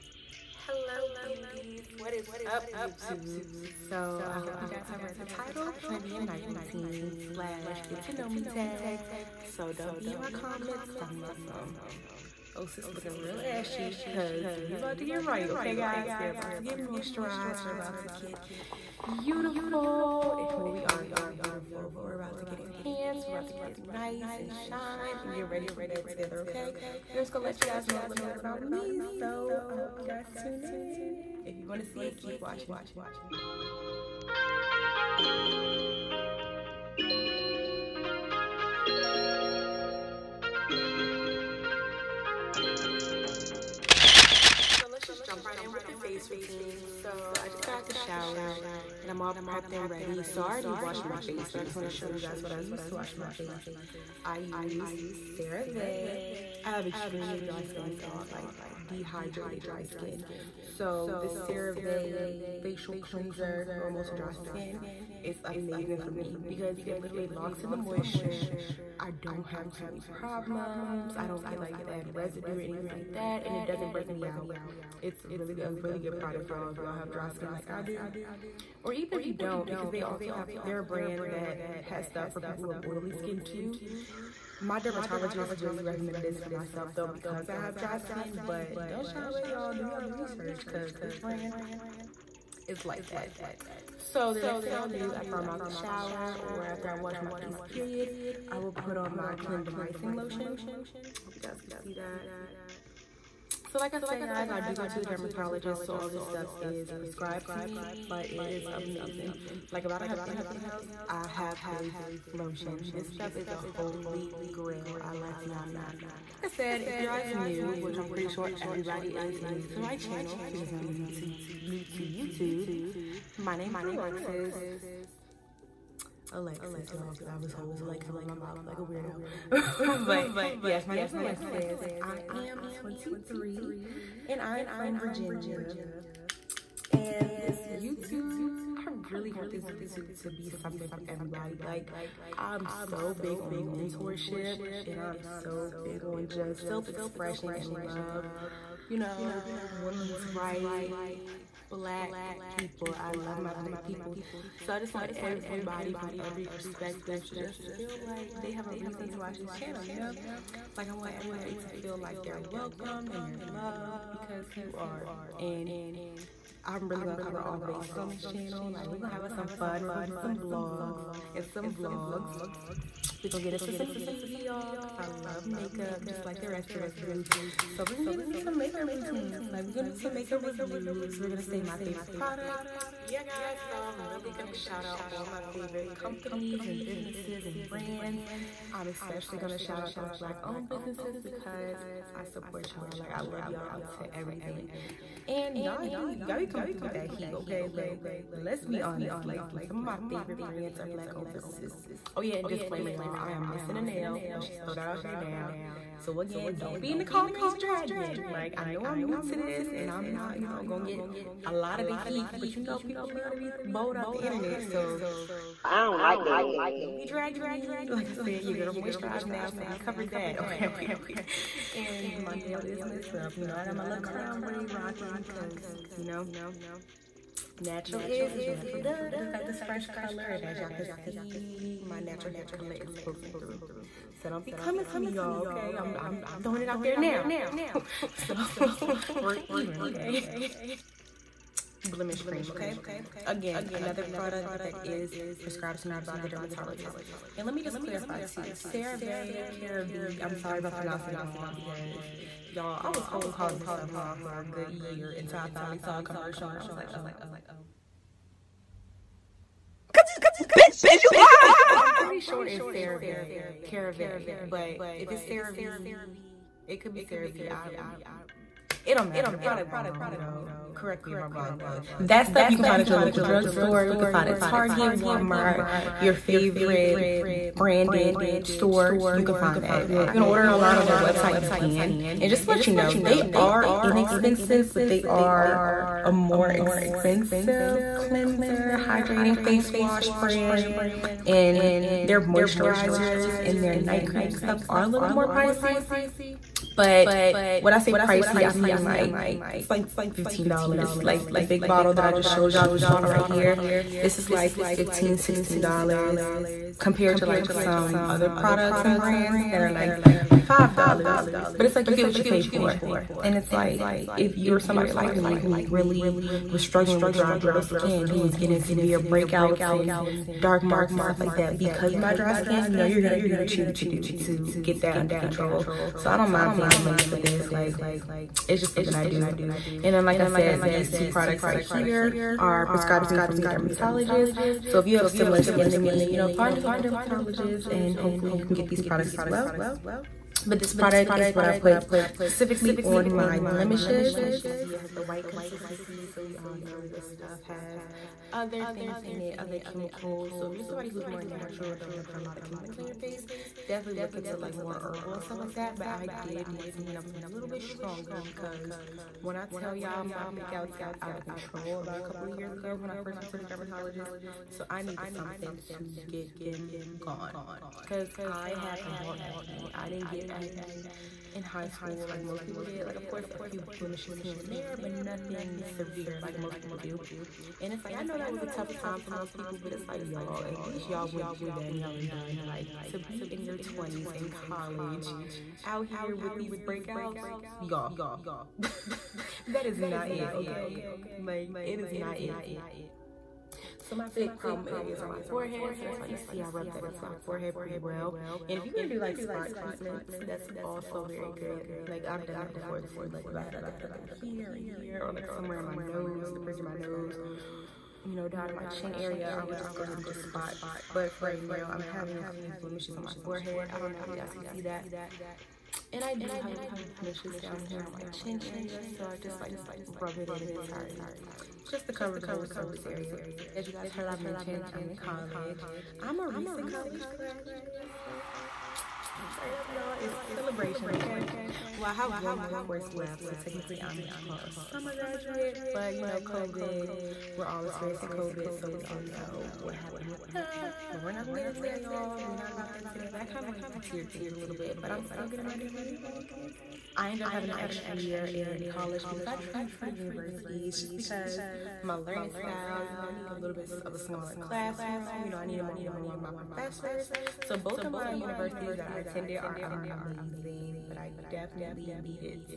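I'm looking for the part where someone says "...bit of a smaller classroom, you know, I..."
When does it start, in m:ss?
7:33.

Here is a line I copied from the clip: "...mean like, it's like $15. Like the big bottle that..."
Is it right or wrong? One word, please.
right.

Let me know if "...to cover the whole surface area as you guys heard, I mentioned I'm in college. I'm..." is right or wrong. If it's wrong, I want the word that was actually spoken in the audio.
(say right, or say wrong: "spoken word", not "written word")
right.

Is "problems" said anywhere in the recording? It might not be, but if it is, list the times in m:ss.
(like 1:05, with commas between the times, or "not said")
1:10, 6:34.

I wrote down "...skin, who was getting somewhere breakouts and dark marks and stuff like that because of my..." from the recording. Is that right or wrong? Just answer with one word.
wrong.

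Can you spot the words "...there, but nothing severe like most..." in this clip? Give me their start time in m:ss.
6:14.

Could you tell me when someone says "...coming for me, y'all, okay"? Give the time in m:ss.
3:54.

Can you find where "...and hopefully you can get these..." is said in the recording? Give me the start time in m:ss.
5:37.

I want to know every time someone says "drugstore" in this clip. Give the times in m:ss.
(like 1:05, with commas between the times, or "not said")
4:33.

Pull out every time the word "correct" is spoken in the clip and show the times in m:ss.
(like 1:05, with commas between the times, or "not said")
4:30.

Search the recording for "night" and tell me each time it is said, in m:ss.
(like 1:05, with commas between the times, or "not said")
0:06, 4:53.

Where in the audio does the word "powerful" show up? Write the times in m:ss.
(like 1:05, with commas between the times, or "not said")
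not said.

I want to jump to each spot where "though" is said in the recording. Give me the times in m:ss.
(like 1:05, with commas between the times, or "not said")
1:26, 4:31.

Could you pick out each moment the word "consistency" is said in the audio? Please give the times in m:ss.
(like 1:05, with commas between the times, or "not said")
5:45.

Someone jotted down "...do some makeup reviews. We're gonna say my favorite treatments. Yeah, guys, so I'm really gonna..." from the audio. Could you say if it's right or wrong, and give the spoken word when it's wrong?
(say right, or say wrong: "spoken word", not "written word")
wrong: "products", not "treatments".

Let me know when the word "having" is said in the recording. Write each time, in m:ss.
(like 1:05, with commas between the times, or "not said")
6:51, 7:27.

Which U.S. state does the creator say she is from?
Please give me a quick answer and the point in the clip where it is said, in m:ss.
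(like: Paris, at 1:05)
Virginia, at 2:14.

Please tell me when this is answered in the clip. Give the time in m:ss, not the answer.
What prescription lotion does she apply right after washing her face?
1:39.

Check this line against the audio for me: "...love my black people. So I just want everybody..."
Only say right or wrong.
right.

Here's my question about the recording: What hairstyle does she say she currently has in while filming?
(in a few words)
Crown braid.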